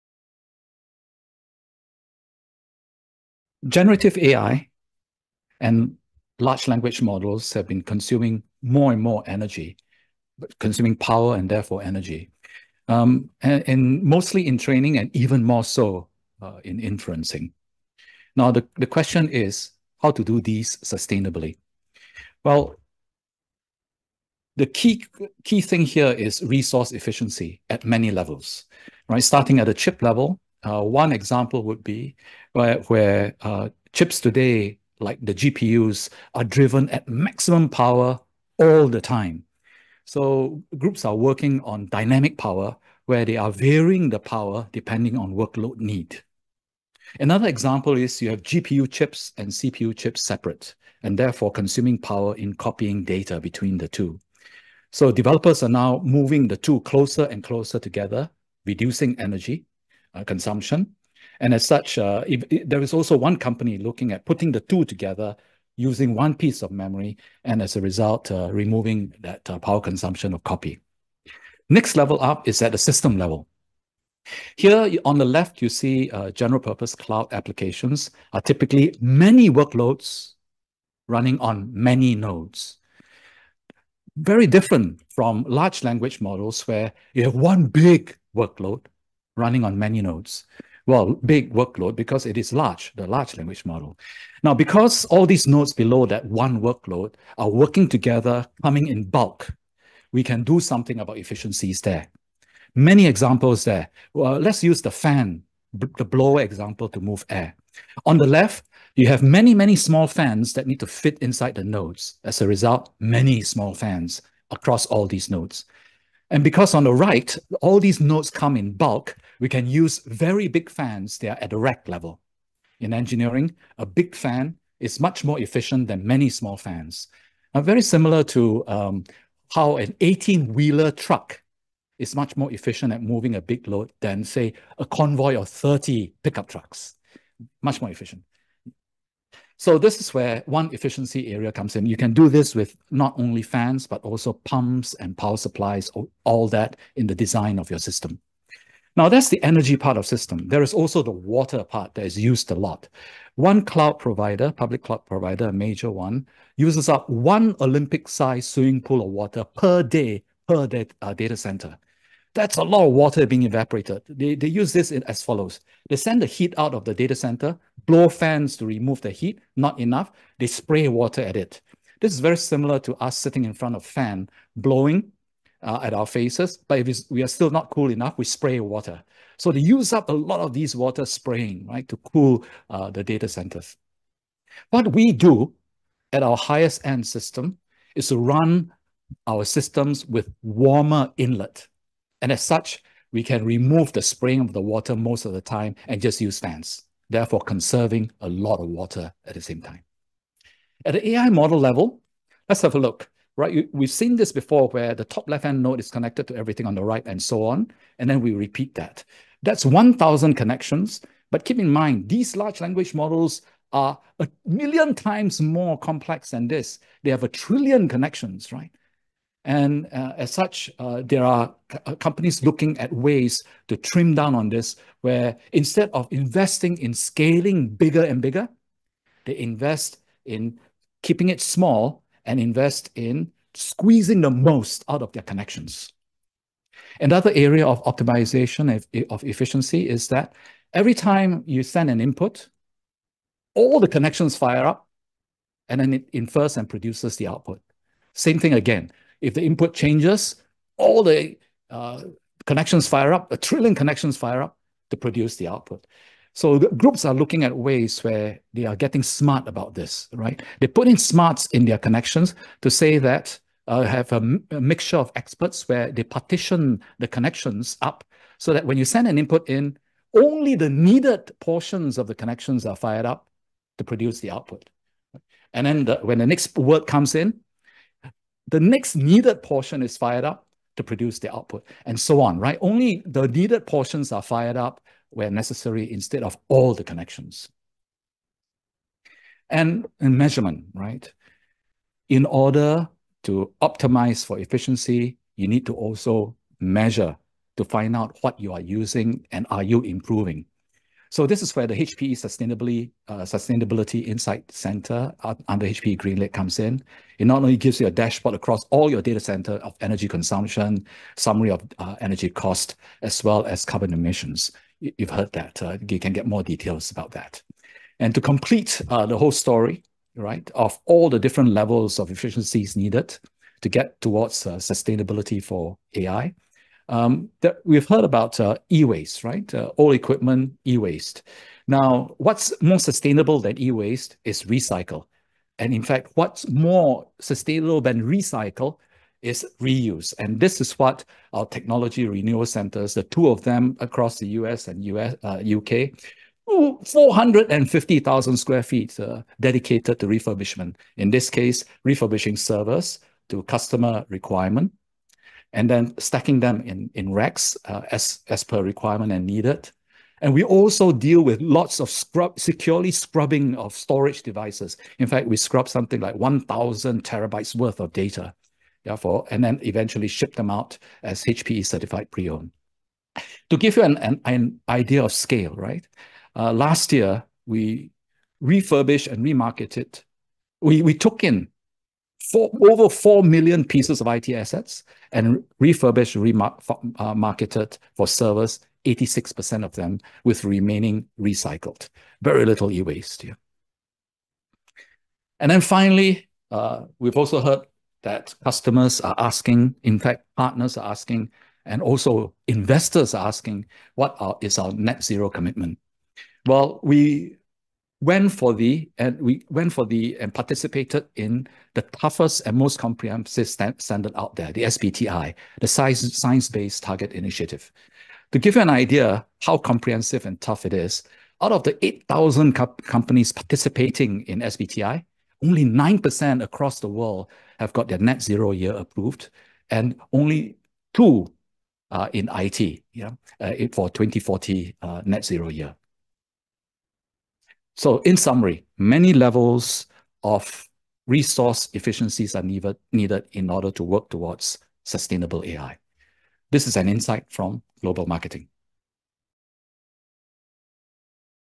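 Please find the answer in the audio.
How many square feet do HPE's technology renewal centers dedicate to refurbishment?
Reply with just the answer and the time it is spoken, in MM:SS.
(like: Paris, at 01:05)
450,000, at 05:46.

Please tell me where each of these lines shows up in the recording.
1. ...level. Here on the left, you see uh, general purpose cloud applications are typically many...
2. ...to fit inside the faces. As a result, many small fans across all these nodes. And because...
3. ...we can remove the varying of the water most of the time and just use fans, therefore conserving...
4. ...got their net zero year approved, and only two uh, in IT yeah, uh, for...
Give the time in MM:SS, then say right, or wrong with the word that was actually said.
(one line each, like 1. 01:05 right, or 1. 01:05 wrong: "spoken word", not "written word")
1. 01:13 right
2. 01:50 wrong: "nodes", not "faces"
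3. 03:13 wrong: "spraying", not "varying"
4. 07:07 right.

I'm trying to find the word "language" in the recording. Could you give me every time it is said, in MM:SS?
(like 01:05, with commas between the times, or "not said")
00:06, 01:25, 01:33, 03:32.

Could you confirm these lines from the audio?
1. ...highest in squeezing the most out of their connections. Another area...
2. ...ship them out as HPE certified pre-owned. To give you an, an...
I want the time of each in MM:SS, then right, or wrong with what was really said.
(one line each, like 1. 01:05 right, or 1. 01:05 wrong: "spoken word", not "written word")
1. 03:52 wrong: "invest", not "highest"
2. 06:10 right.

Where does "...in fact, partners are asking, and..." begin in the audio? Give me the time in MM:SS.
06:39.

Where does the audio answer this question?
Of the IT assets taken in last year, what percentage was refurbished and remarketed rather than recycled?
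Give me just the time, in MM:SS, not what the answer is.
06:28.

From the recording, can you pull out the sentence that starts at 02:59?
So they use up a lot of these water spraying, right, to cool uh, the data centers.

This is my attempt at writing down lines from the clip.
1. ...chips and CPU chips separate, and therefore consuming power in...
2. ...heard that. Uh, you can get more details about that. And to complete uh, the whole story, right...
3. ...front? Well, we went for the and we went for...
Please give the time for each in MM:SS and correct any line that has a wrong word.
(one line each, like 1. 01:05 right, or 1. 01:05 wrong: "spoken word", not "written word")
1. 00:48 right
2. 05:15 right
3. 06:45 wrong: "commitment", not "front".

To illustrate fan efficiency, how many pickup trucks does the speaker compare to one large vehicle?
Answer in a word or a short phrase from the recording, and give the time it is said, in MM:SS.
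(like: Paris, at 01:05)
30, at 02:15.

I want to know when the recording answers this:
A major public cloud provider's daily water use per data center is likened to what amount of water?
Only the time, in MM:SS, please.
02:37.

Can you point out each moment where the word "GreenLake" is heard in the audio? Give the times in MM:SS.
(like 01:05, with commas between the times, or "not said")
05:05.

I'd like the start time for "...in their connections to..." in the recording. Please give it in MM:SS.
04:21.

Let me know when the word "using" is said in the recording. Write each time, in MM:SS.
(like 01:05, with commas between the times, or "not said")
01:05, 04:58.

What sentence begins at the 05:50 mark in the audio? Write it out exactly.
In this case, refurbishing servers to customer requirement, and then stacking them in, in racks uh, as, as per requirement and needed.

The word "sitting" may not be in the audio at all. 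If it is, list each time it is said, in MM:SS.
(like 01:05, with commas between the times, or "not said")
02:53.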